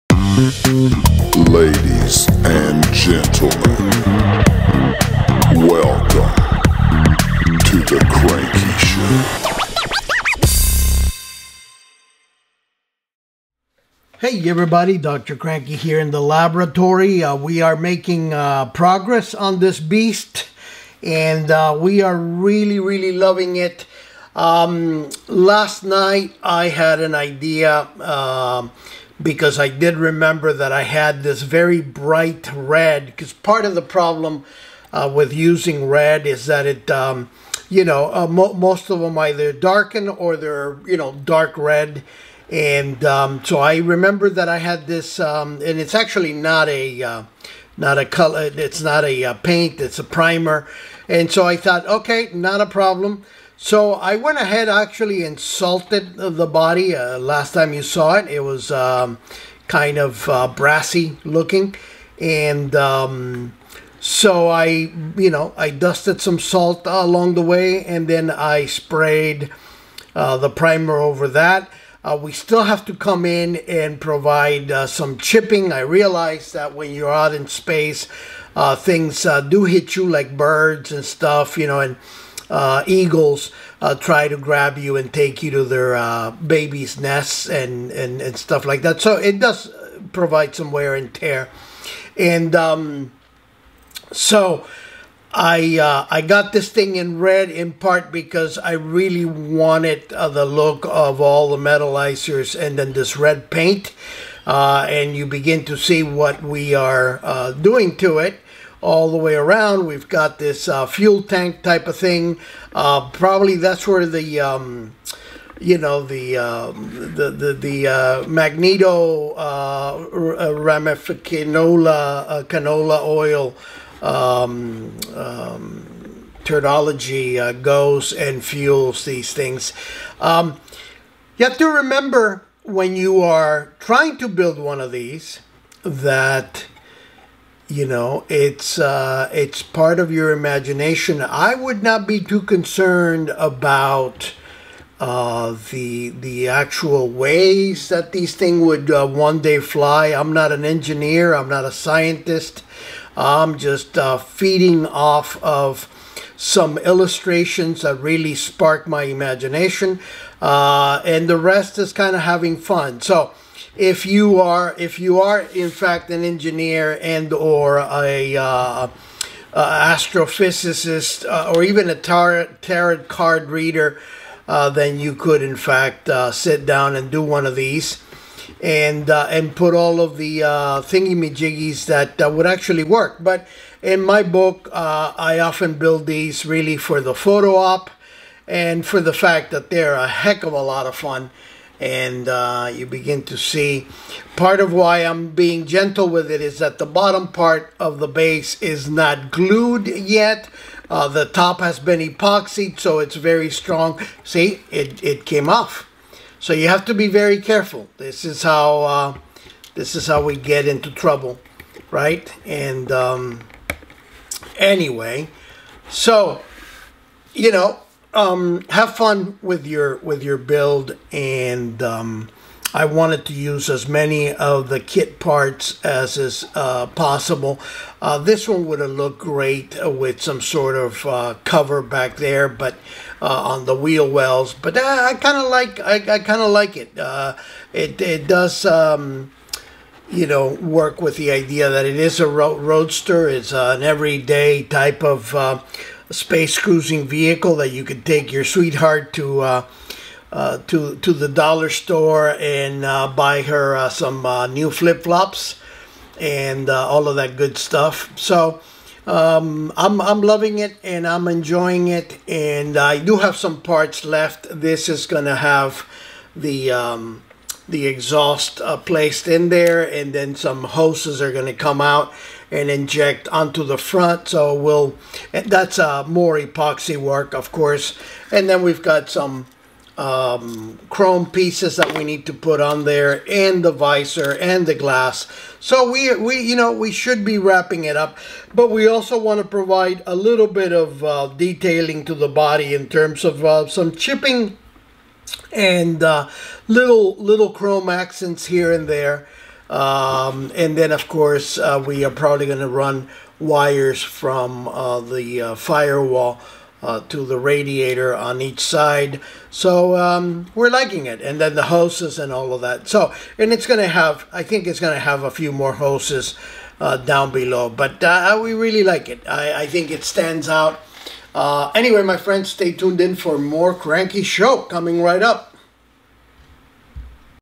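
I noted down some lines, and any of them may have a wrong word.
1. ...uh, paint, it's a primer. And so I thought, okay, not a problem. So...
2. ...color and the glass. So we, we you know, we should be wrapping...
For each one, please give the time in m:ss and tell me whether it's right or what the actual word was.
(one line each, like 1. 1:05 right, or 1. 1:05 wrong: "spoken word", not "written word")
1. 0:49 right
2. 4:43 wrong: "visor", not "color".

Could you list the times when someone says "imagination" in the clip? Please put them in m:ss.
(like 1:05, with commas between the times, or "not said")
2:20, 2:39.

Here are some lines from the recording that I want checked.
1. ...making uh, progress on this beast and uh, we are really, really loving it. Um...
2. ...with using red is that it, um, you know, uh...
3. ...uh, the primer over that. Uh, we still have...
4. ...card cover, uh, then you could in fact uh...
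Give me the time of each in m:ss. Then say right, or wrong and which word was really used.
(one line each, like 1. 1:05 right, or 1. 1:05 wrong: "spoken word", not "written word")
1. 0:17 right
2. 0:35 right
3. 1:10 right
4. 2:53 wrong: "reader", not "cover".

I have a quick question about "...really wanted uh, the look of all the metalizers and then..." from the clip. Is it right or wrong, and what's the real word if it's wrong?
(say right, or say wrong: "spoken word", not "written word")
right.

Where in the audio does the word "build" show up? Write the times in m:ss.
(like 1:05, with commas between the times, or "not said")
2:14, 3:05, 3:40.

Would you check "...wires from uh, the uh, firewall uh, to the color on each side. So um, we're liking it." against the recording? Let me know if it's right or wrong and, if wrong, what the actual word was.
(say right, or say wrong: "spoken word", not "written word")
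wrong: "radiator", not "color".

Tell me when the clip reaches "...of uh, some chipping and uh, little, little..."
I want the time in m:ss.
4:53.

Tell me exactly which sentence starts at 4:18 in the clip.
So um, I'm I'm loving it and I'm enjoying it and I do have some parts left.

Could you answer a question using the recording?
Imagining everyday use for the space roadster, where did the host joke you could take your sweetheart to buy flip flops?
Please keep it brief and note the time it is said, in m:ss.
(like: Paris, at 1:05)
The dollar store, at 4:11.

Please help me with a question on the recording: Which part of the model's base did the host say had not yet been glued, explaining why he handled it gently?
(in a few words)
The bottom part.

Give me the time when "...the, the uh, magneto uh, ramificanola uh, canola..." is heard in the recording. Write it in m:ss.
1:57.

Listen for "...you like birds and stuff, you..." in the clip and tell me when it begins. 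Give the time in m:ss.
1:19.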